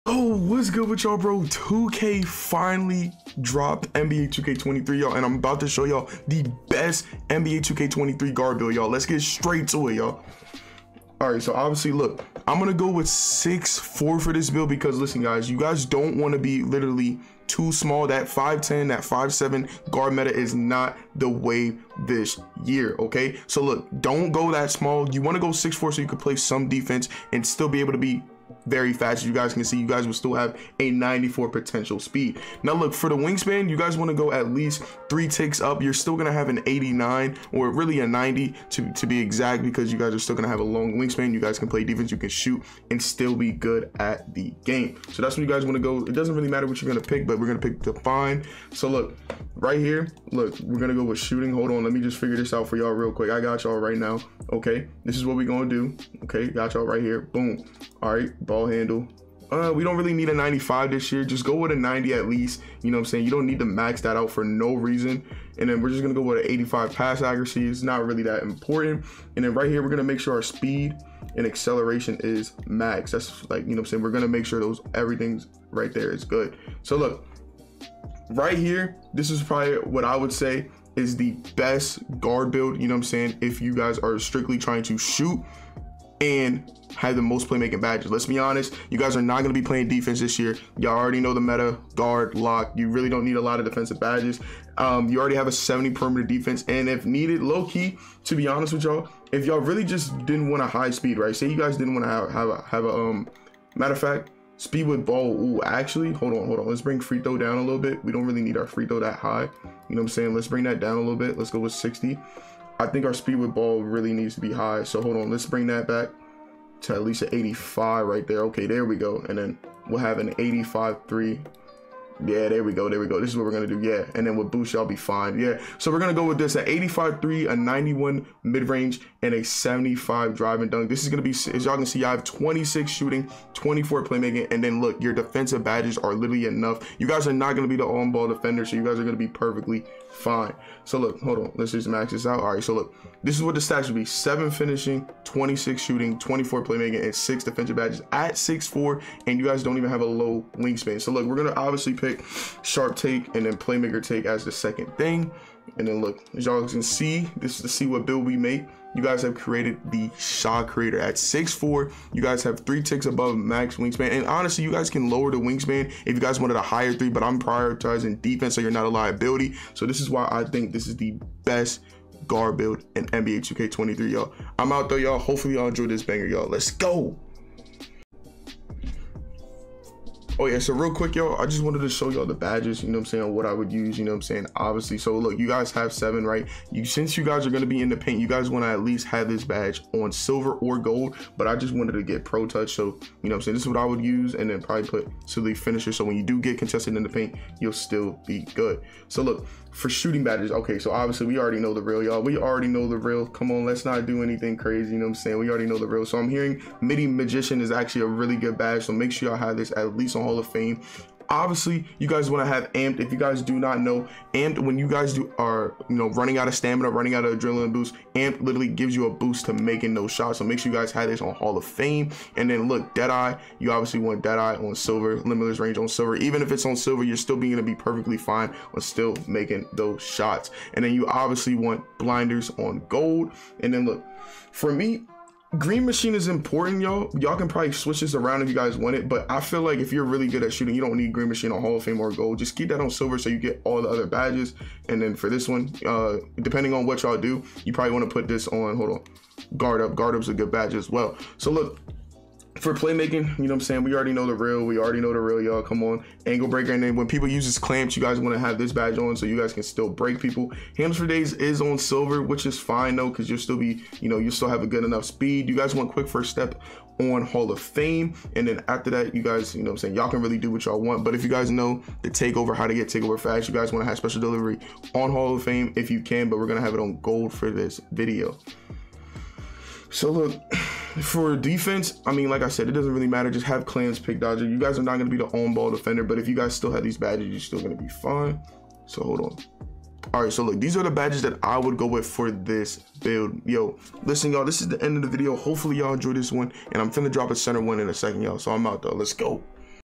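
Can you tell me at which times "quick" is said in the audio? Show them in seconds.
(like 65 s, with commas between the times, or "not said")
53 s, 180 s, 265 s.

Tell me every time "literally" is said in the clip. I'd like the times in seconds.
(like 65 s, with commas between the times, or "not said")
16 s, 136 s, 218 s.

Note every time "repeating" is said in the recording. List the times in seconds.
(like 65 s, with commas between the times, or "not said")
not said.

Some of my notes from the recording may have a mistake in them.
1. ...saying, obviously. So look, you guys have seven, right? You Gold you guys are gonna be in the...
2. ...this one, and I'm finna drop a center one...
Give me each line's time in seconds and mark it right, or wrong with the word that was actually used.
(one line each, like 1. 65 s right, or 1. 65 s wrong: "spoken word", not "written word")
1. 184 s wrong: "Since", not "Gold"
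2. 296 s right.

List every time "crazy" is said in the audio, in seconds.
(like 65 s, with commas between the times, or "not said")
204 s.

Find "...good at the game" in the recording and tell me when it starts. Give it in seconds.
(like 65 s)
43 s.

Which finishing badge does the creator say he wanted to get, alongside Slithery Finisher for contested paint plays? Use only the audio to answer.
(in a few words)
Pro Touch.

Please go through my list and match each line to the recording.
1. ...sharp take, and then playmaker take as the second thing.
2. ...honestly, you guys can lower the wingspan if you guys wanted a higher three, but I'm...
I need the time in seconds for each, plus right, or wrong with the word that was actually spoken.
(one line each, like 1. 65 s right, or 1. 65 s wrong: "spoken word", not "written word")
1. 152 s right
2. 164 s right.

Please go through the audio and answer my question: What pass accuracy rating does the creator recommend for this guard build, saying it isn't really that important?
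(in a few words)
85.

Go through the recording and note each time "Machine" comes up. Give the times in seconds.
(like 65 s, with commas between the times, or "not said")
235 s, 241 s.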